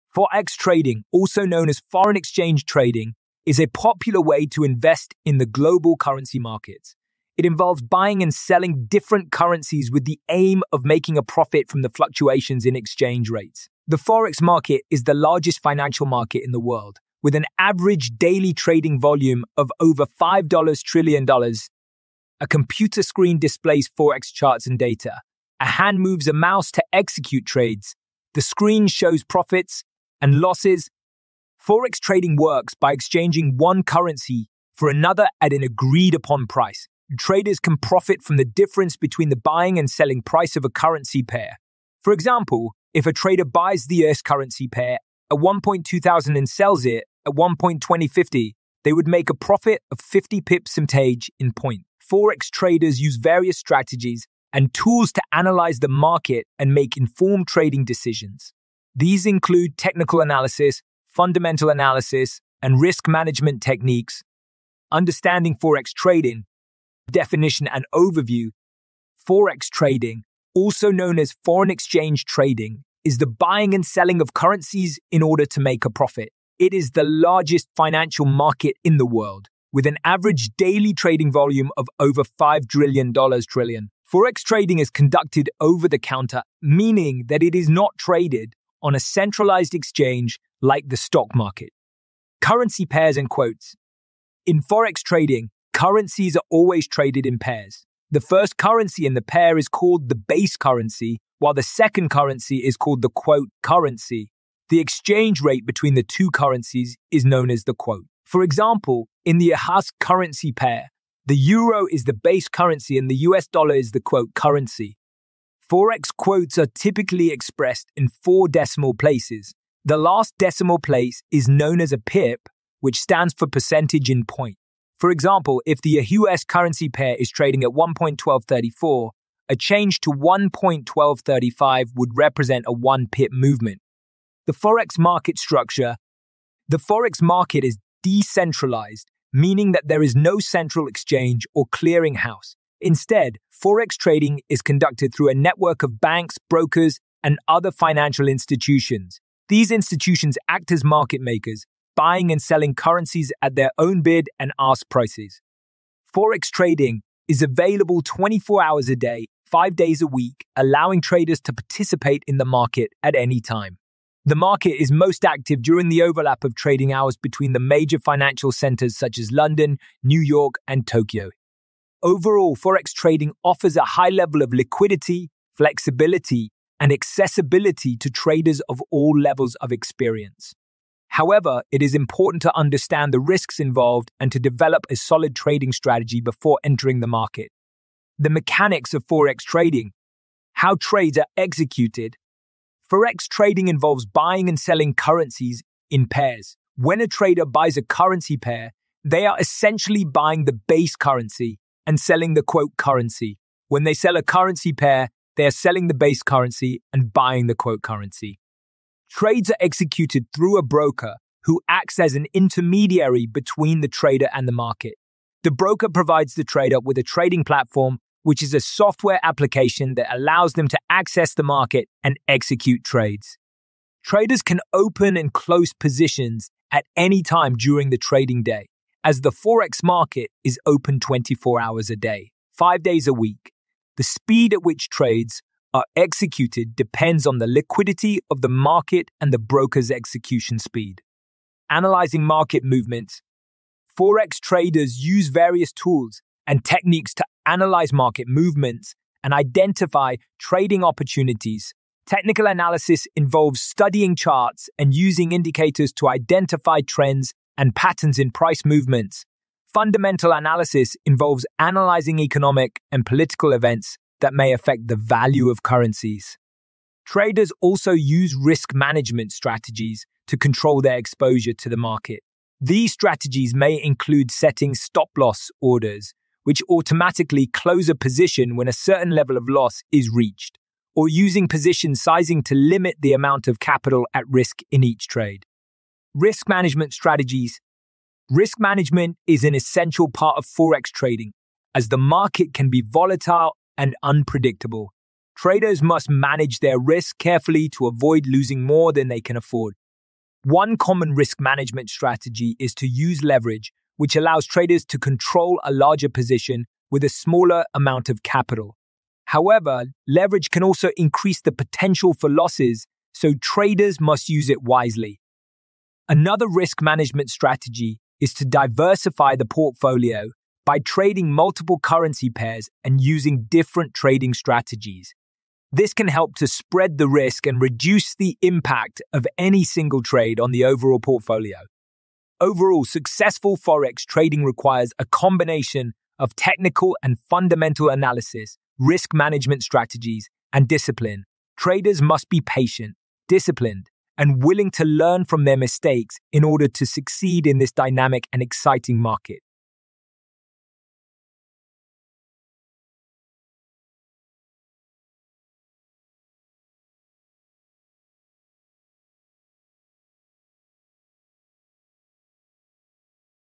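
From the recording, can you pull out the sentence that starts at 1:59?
The last decimal place is known as a pip, which stands for percentage in point.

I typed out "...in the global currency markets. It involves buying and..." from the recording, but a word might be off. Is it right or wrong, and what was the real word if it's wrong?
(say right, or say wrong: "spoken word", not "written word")
right.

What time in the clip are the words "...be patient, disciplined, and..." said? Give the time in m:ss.
5:42.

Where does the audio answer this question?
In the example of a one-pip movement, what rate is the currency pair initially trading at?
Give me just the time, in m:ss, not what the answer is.
2:07.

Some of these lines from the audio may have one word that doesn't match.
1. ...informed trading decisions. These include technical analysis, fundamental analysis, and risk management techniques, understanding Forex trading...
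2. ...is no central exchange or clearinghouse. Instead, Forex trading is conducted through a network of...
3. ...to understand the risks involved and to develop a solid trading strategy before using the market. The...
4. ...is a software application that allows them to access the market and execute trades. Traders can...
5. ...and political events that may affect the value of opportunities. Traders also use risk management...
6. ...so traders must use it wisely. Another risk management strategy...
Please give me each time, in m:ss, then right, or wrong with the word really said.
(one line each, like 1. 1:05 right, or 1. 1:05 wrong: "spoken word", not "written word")
1. 0:56 right
2. 2:20 right
3. 3:02 wrong: "entering", not "using"
4. 3:38 right
5. 4:22 wrong: "currencies", not "opportunities"
6. 5:13 right.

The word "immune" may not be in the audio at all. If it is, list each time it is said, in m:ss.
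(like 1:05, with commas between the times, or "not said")
not said.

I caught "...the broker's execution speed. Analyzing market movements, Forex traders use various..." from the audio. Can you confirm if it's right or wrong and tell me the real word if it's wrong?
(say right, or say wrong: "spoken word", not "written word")
right.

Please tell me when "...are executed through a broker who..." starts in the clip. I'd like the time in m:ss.
3:29.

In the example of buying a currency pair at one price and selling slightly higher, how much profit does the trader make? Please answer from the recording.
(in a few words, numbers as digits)
50 pips.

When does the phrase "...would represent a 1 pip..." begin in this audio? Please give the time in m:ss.
2:11.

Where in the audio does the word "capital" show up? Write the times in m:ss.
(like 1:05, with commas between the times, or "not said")
4:43, 5:08.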